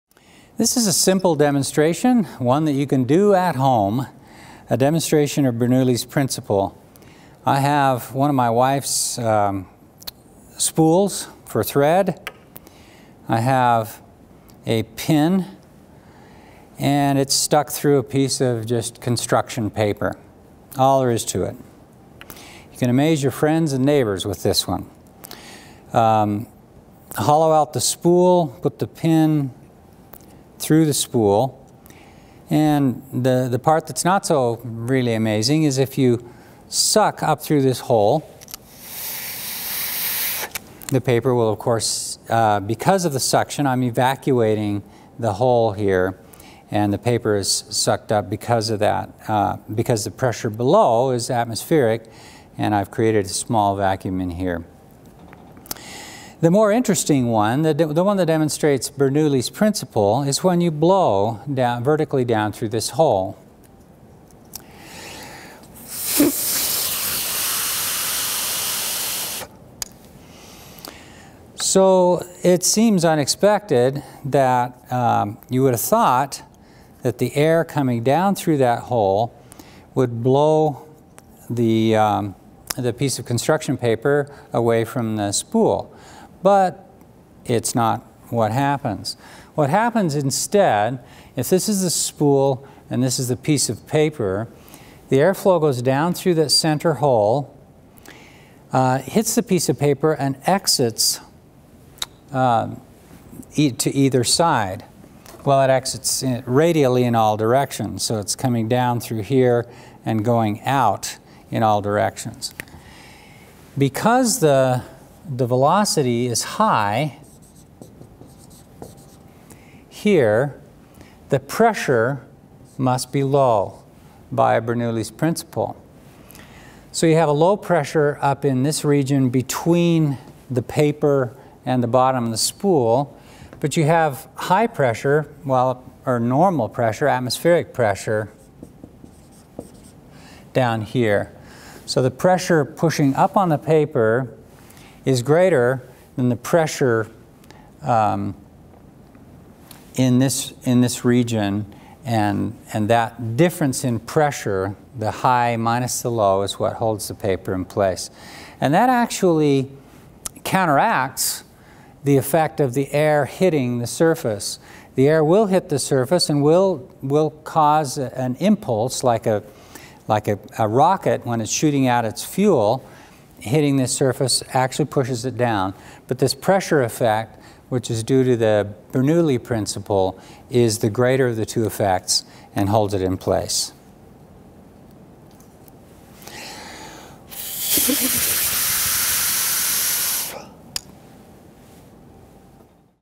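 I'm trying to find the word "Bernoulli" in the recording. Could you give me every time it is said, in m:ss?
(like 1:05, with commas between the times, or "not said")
0:05, 0:58, 2:04, 2:58.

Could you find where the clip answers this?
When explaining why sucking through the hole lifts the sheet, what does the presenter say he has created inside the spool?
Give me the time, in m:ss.
0:53.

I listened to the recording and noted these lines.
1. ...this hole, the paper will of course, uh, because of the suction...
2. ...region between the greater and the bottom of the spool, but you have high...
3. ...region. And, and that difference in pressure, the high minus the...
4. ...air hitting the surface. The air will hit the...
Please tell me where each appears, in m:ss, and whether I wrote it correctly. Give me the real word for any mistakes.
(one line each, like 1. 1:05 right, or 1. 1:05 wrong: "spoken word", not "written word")
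1. 0:37 right
2. 2:08 wrong: "paper", not "greater"
3. 2:31 right
4. 2:42 right.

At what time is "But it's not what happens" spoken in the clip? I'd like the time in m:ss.
1:26.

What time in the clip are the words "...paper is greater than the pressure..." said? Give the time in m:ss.
2:23.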